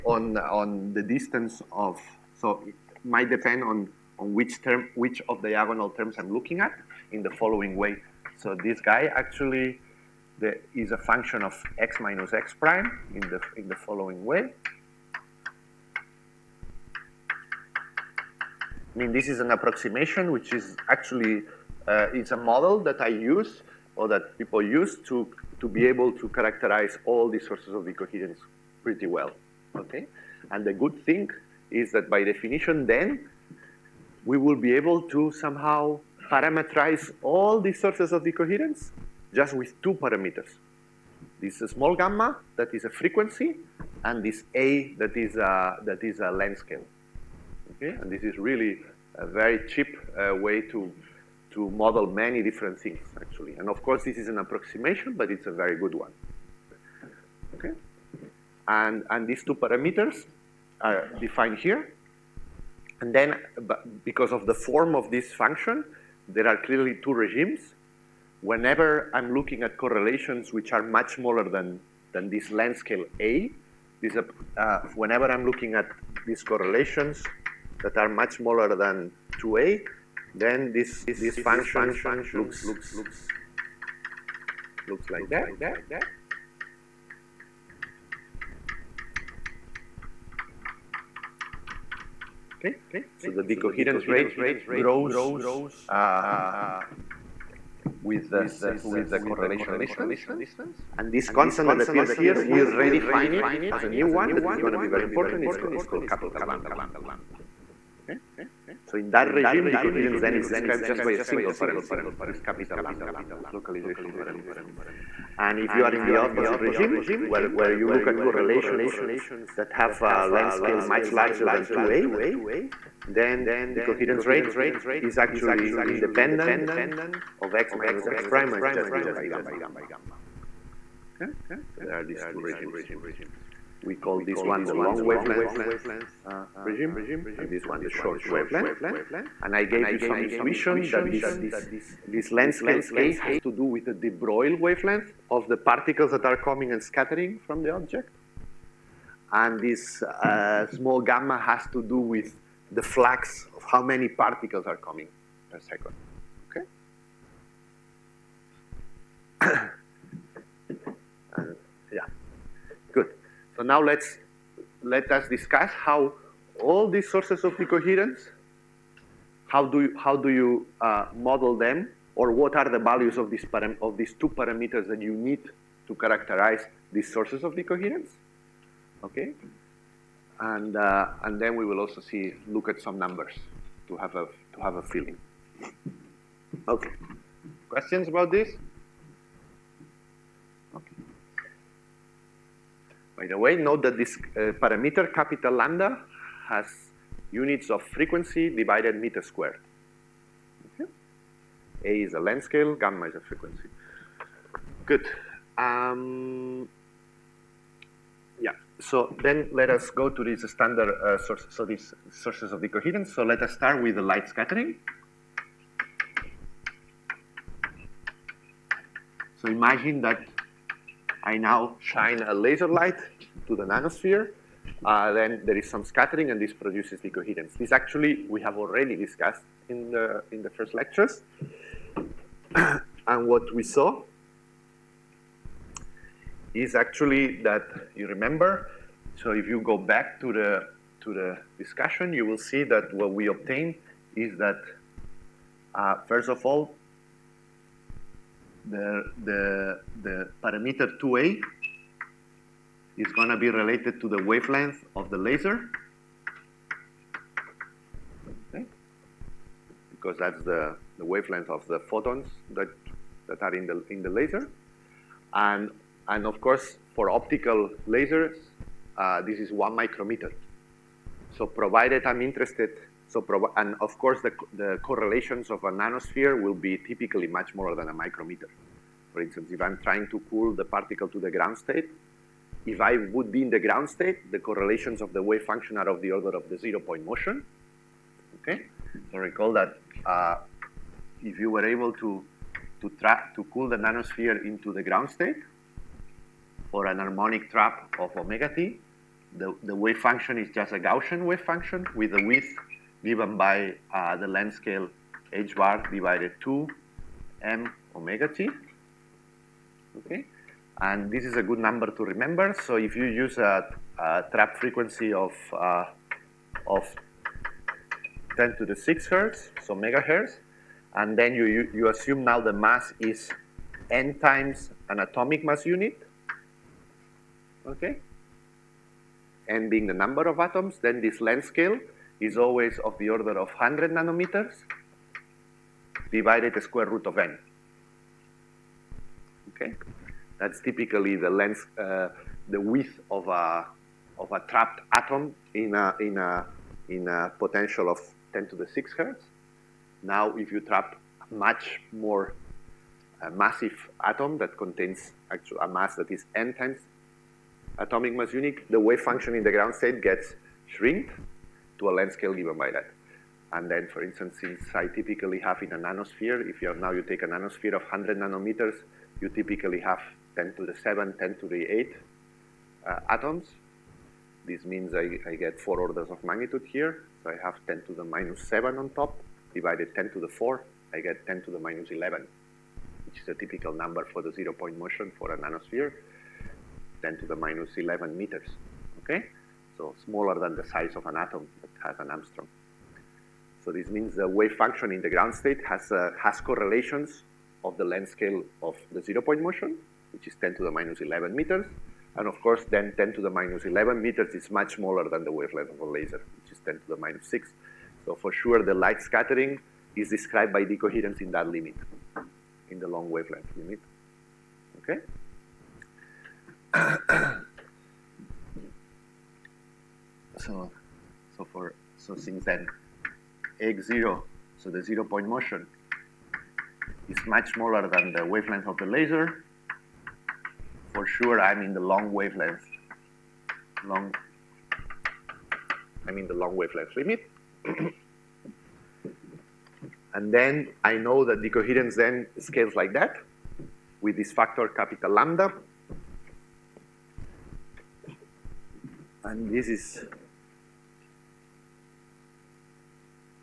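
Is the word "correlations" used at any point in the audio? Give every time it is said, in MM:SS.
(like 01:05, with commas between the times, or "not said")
01:09, 01:16, 01:39, 01:58, 04:34, 04:44, 06:36.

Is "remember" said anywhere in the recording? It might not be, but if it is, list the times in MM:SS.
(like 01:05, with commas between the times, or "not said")
03:58, 05:12.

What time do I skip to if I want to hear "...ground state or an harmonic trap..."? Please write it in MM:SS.
04:54.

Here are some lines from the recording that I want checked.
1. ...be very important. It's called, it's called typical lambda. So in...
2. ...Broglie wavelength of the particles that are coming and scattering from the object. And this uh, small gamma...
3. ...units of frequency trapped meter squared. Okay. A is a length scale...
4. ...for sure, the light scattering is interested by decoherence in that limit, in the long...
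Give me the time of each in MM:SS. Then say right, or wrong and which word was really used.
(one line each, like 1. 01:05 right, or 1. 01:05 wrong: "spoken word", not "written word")
1. 01:44 wrong: "capital", not "typical"
2. 02:24 right
3. 03:17 wrong: "divided", not "trapped"
4. 06:48 wrong: "described", not "interested".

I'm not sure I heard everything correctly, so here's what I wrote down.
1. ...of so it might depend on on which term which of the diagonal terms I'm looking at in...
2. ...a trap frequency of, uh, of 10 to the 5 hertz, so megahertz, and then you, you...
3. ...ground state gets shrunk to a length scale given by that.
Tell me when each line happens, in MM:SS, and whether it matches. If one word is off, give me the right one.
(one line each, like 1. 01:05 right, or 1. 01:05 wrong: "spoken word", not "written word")
1. 00:01 right
2. 05:13 wrong: "6", not "5"
3. 05:59 right.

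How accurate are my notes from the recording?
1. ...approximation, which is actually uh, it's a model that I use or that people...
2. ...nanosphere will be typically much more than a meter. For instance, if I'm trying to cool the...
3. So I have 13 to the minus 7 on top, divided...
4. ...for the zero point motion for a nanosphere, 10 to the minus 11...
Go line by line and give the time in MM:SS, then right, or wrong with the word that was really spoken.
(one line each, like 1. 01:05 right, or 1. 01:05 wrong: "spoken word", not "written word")
1. 00:19 right
2. 04:35 wrong: "micrometer", not "meter"
3. 06:17 wrong: "10", not "13"
4. 06:24 right.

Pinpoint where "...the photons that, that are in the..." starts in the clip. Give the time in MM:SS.
04:21.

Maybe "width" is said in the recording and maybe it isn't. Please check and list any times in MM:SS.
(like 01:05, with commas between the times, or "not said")
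05:02, 05:42.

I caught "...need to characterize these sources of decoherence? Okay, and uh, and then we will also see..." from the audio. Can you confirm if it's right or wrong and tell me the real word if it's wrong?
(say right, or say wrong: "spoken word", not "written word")
right.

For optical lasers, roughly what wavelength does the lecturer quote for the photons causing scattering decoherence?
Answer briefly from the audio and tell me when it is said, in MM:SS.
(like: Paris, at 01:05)
1 micrometer, at 04:29.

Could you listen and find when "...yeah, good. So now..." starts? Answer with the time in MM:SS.
02:41.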